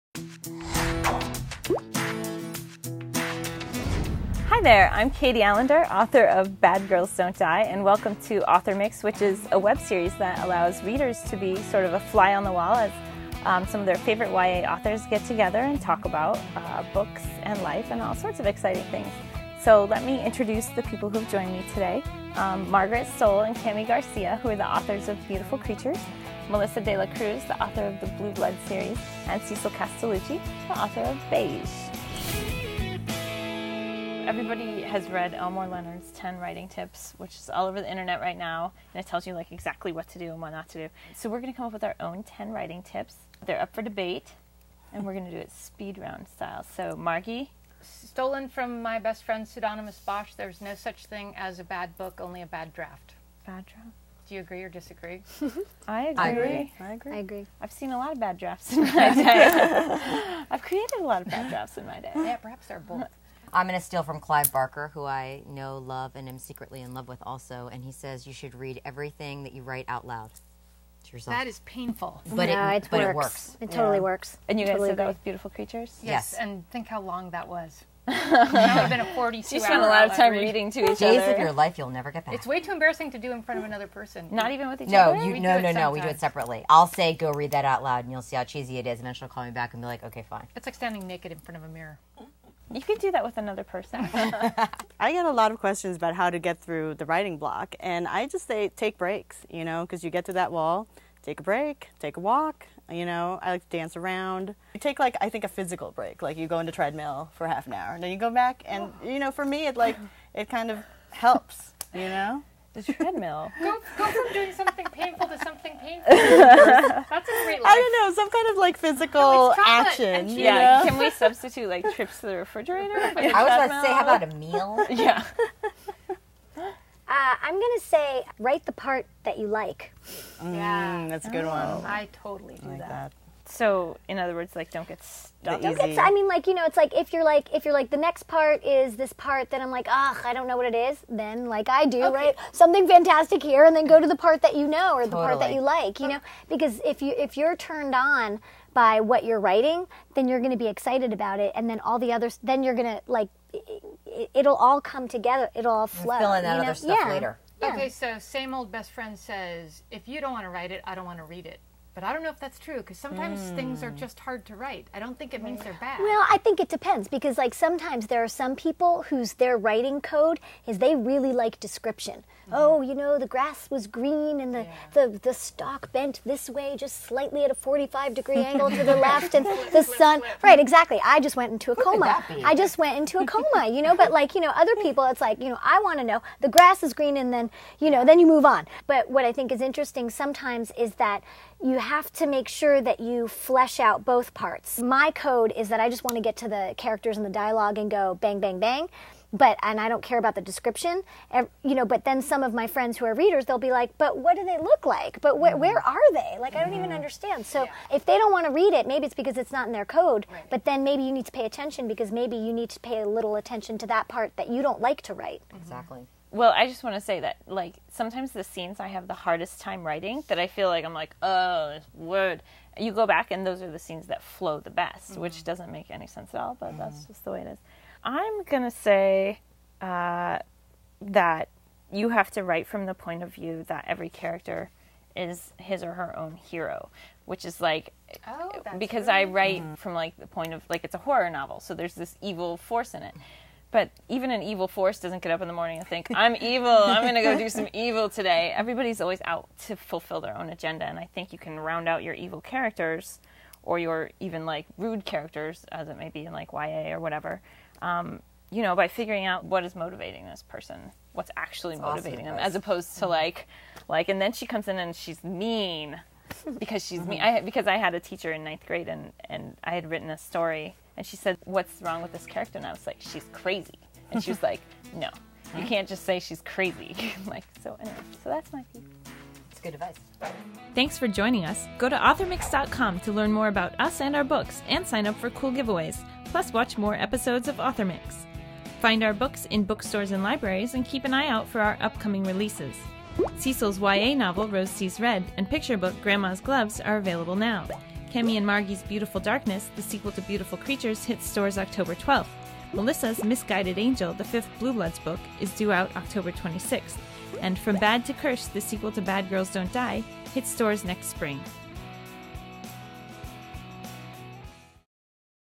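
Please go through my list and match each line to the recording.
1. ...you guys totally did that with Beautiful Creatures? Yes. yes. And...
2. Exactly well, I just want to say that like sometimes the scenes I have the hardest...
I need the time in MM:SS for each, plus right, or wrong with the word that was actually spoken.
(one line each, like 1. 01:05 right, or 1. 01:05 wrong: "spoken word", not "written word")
1. 01:14 right
2. 03:35 right.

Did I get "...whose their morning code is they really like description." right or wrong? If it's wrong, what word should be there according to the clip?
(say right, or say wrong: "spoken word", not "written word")
wrong: "writing", not "morning".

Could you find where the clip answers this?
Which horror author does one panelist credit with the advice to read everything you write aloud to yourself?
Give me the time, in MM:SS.
01:04.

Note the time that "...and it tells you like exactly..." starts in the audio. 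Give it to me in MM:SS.
00:38.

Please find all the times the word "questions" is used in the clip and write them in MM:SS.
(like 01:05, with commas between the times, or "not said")
01:35.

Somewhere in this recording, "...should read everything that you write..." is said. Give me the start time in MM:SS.
01:08.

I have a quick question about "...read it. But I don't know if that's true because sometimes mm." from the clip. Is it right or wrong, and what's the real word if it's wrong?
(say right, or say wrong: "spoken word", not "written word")
right.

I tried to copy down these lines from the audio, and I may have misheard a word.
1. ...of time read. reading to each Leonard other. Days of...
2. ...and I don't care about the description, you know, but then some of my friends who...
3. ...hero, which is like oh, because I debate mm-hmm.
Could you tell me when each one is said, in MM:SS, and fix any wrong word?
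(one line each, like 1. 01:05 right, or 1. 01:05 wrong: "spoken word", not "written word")
1. 01:20 wrong: "Days", not "Leonard"
2. 03:19 right
3. 03:56 wrong: "write", not "debate".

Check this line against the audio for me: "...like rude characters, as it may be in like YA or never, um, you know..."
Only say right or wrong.
wrong.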